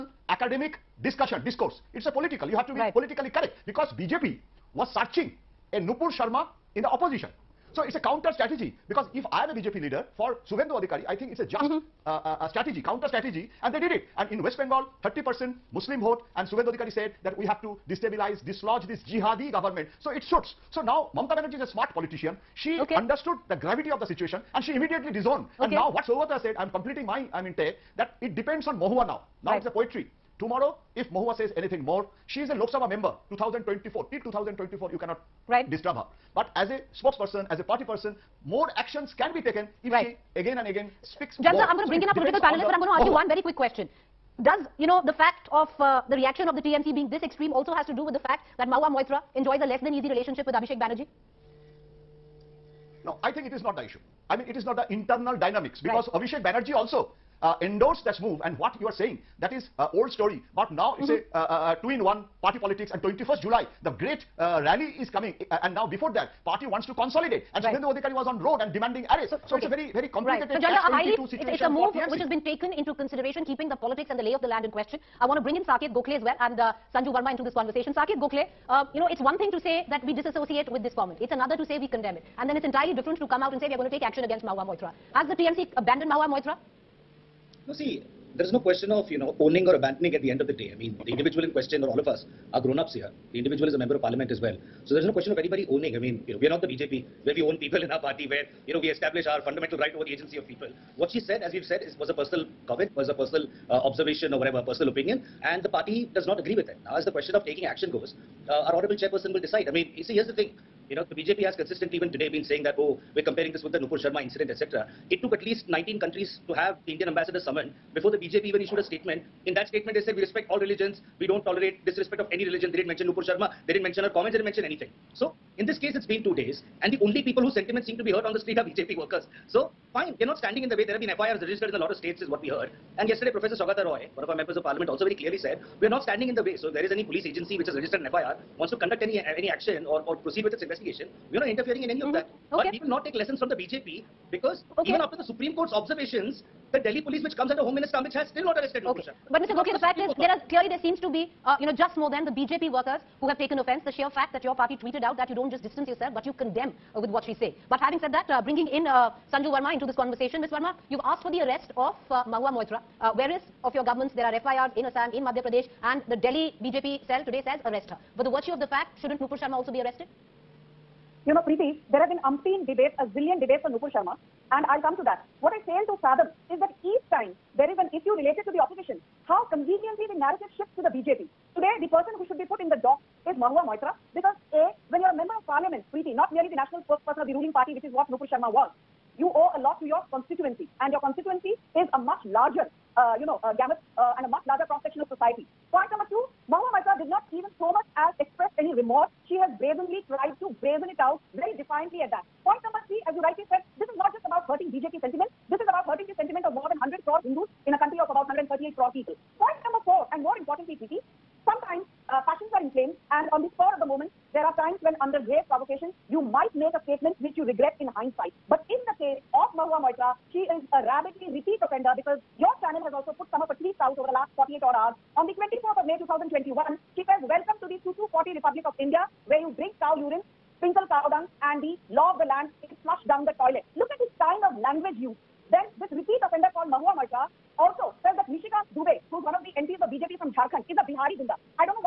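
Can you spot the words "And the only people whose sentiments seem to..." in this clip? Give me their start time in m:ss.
2:06.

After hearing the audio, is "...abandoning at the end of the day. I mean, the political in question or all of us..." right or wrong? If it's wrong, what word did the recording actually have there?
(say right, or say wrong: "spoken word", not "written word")
wrong: "individual", not "political".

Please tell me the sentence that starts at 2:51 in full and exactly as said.
You know, Preeti, there have been umpteen debates, a zillion debates on Nupur Sharma, and I'll come to that.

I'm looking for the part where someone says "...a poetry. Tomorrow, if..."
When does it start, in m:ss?
0:29.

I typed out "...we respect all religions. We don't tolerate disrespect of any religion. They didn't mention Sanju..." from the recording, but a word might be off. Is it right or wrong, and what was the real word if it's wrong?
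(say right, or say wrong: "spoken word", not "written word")
wrong: "Nupur", not "Sanju".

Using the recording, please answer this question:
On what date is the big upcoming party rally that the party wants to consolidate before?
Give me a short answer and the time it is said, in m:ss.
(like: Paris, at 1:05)
21st July, at 1:03.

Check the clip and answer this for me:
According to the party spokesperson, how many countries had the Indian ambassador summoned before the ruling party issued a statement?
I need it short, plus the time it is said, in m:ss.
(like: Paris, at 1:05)
19, at 1:55.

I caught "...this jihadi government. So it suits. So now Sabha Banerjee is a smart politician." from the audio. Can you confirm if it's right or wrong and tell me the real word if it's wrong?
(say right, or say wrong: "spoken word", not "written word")
wrong: "Mamta", not "Sabha".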